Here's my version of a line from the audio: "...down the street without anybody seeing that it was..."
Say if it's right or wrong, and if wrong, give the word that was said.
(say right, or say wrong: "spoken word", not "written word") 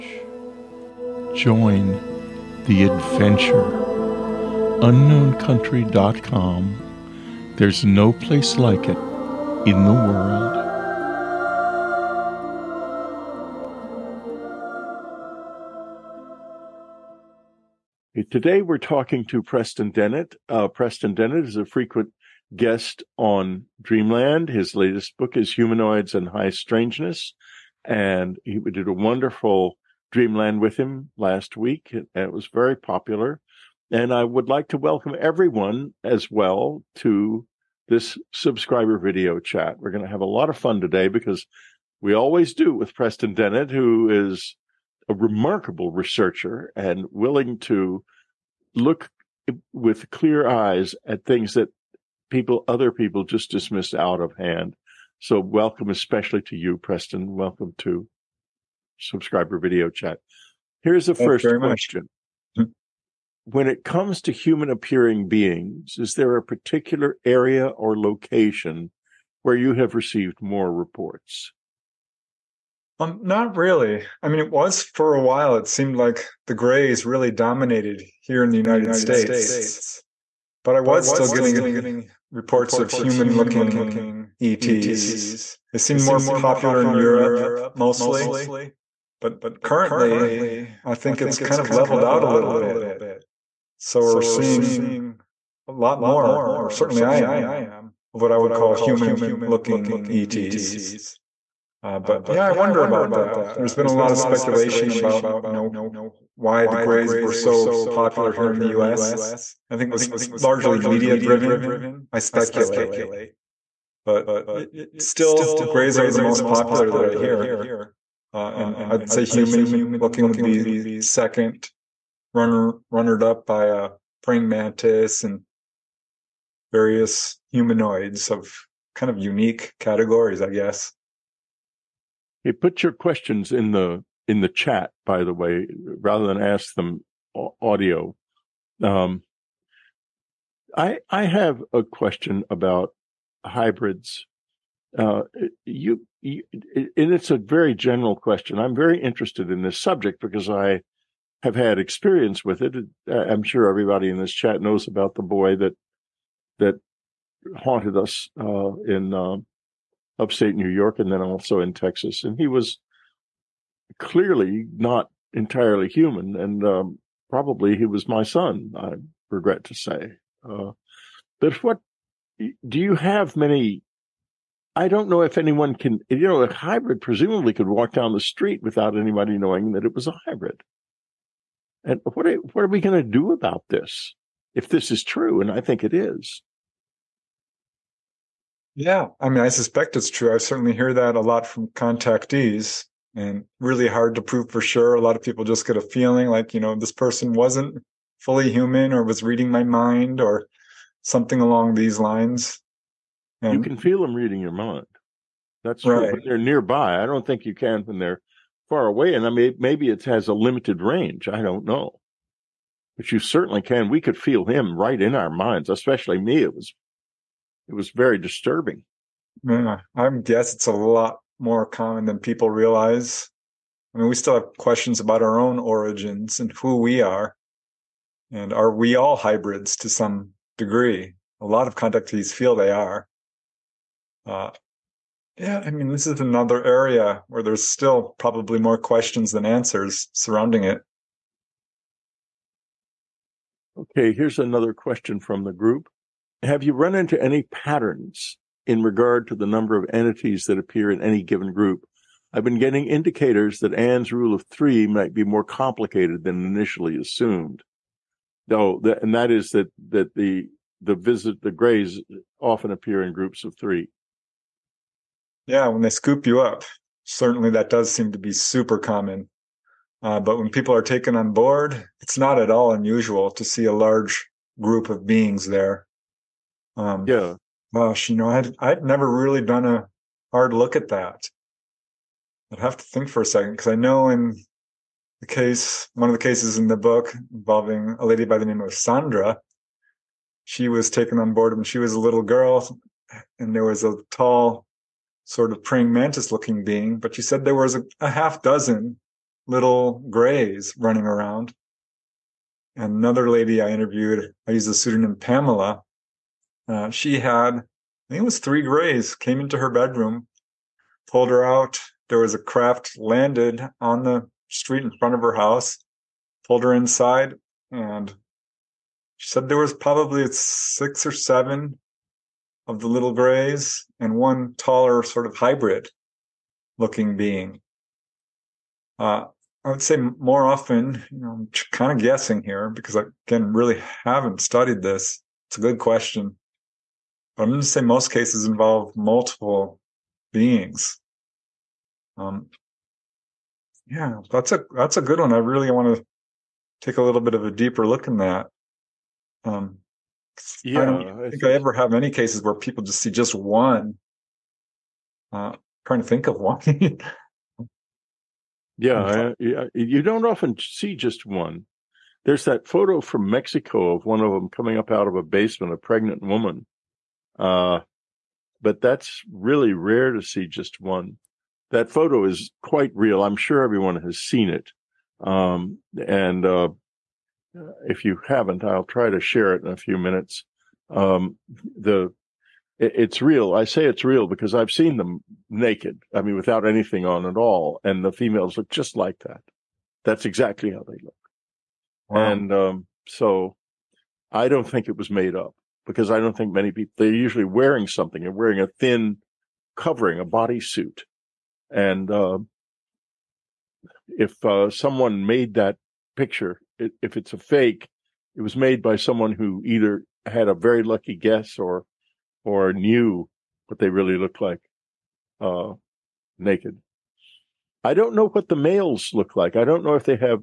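wrong: "knowing", not "seeing".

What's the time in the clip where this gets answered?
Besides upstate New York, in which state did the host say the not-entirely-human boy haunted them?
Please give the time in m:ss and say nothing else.
2:41.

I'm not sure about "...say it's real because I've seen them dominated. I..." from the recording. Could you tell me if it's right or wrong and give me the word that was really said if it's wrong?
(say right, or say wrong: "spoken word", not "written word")
wrong: "naked", not "dominated".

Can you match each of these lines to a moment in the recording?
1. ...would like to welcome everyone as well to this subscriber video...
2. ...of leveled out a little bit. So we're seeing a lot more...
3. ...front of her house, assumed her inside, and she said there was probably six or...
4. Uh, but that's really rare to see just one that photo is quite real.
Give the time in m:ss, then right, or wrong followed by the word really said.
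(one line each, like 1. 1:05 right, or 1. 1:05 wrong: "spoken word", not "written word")
1. 0:34 right
2. 1:31 right
3. 5:14 wrong: "pulled", not "assumed"
4. 6:07 right.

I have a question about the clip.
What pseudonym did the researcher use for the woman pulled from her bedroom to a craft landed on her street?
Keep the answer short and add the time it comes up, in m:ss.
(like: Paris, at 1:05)
Pamela, at 5:05.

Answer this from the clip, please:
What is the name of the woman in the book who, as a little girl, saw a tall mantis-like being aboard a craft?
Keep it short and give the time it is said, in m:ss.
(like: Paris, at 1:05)
Sandra, at 4:48.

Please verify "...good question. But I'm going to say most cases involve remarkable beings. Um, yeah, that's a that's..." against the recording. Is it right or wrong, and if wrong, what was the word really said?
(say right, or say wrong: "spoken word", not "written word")
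wrong: "multiple", not "remarkable".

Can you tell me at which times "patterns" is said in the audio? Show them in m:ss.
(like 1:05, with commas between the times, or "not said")
4:07.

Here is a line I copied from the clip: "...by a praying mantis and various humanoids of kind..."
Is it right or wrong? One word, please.
right.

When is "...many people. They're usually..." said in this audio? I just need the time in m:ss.
6:36.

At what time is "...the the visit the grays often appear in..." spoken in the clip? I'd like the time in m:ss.
4:20.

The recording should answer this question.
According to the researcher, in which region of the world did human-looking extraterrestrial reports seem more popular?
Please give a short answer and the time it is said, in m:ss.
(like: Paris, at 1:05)
Europe, at 1:26.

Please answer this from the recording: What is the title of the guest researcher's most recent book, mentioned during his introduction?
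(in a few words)
Humanoids and High Strangeness.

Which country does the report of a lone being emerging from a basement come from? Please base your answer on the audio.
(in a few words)
Mexico.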